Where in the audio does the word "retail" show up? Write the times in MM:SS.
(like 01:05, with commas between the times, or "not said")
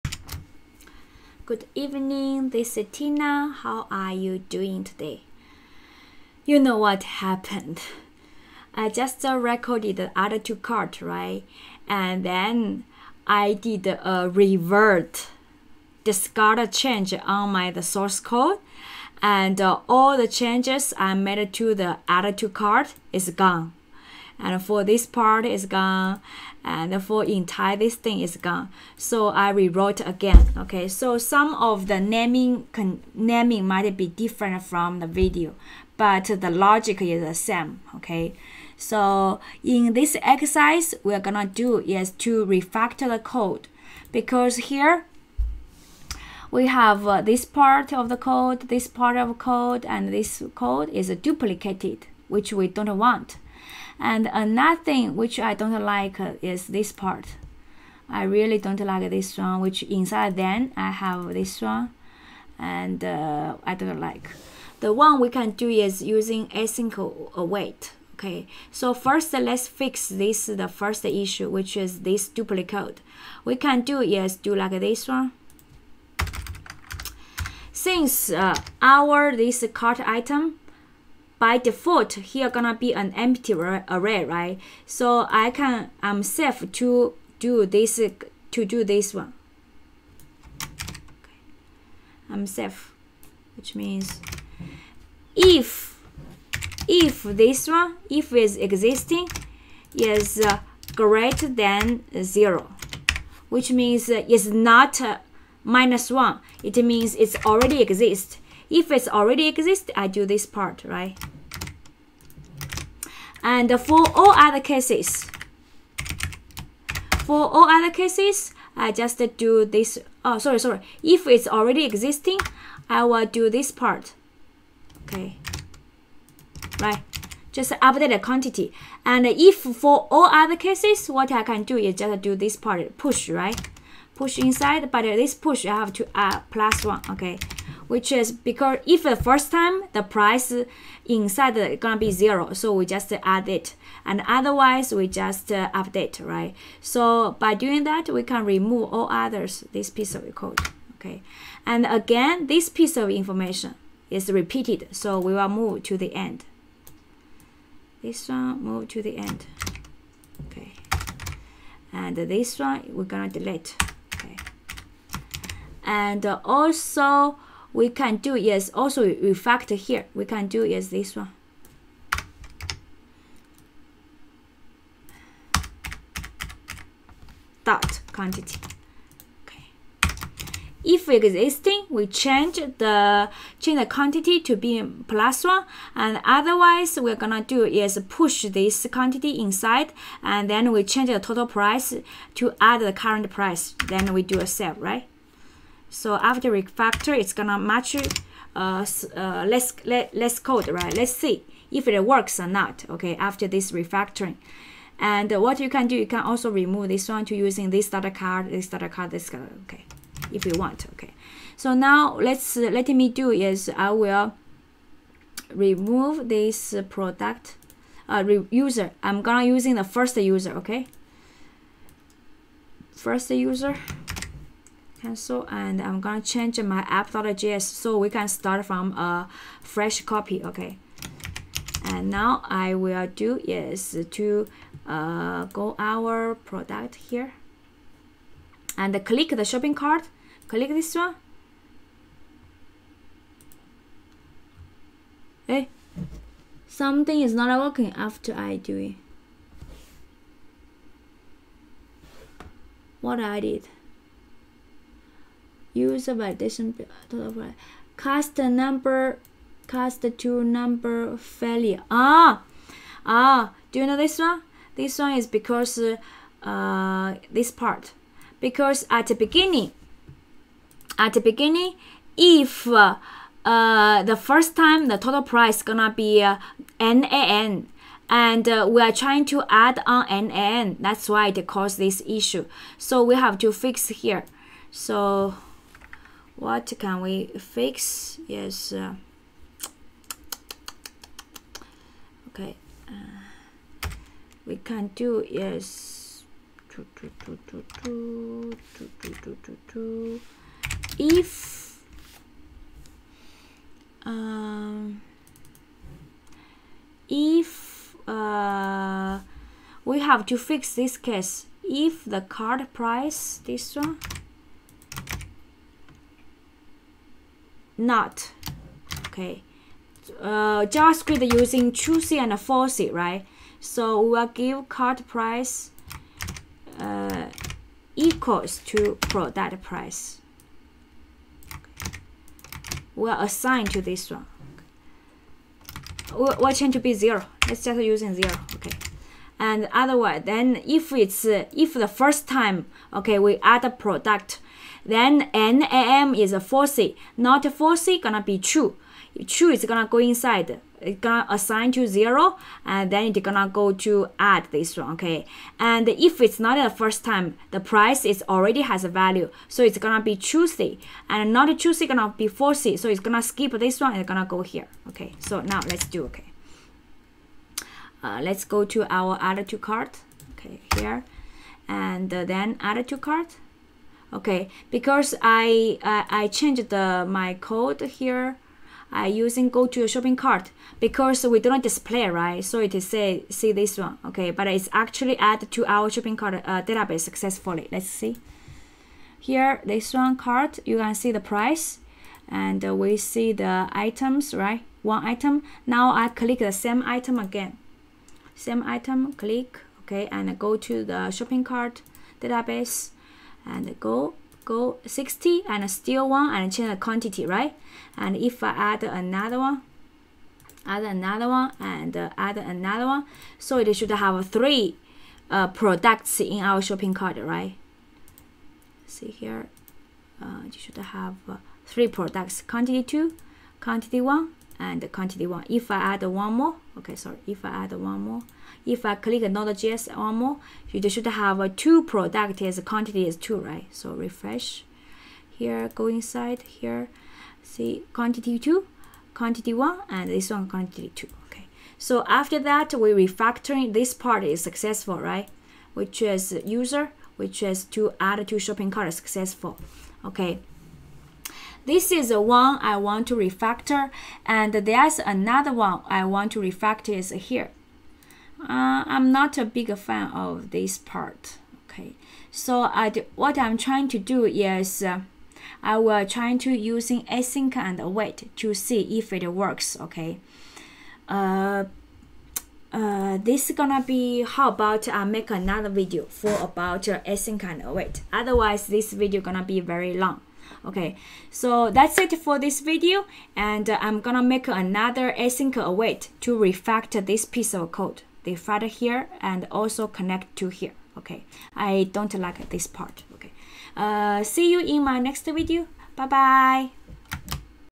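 not said.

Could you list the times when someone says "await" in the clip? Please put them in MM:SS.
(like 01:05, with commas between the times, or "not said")
01:07, 07:47, 07:57, 08:05.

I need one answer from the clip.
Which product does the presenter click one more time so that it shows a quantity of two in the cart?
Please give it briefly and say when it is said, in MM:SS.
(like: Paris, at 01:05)
Node.js, at 07:09.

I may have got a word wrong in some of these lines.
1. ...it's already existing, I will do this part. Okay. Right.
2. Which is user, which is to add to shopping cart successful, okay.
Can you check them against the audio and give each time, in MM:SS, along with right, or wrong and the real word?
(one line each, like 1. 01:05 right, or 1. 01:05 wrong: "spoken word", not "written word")
1. 02:01 right
2. 07:25 right.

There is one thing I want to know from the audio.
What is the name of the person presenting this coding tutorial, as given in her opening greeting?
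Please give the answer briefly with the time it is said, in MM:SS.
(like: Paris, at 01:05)
Tina, at 00:02.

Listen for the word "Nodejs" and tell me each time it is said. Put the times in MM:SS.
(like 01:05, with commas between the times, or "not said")
07:09.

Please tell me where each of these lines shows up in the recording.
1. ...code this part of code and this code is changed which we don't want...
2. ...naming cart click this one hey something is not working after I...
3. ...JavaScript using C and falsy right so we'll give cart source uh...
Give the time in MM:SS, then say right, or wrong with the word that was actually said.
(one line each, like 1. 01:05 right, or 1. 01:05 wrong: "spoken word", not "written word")
1. 00:48 wrong: "duplicated", not "changed"
2. 03:59 wrong: "shopping", not "naming"
3. 05:20 wrong: "price", not "source".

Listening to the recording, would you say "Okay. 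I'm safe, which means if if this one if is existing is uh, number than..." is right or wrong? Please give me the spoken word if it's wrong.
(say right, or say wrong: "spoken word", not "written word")
wrong: "greater", not "number".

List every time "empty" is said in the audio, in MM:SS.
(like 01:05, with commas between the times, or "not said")
01:23.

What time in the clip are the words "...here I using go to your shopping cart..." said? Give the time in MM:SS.
06:17.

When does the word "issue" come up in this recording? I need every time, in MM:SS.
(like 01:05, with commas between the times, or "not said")
01:11, 04:42.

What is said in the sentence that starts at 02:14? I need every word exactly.
Push inside, but this push I have to add plus one, okay?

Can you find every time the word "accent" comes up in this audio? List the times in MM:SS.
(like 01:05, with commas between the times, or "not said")
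not said.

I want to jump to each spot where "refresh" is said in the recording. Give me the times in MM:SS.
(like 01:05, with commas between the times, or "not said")
07:13.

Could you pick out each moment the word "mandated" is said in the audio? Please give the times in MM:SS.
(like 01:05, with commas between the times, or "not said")
not said.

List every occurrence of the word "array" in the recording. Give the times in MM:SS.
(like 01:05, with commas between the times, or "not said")
01:23.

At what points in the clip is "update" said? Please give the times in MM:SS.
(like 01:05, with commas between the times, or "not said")
02:07, 02:25.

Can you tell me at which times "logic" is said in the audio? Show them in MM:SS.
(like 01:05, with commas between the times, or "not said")
00:36.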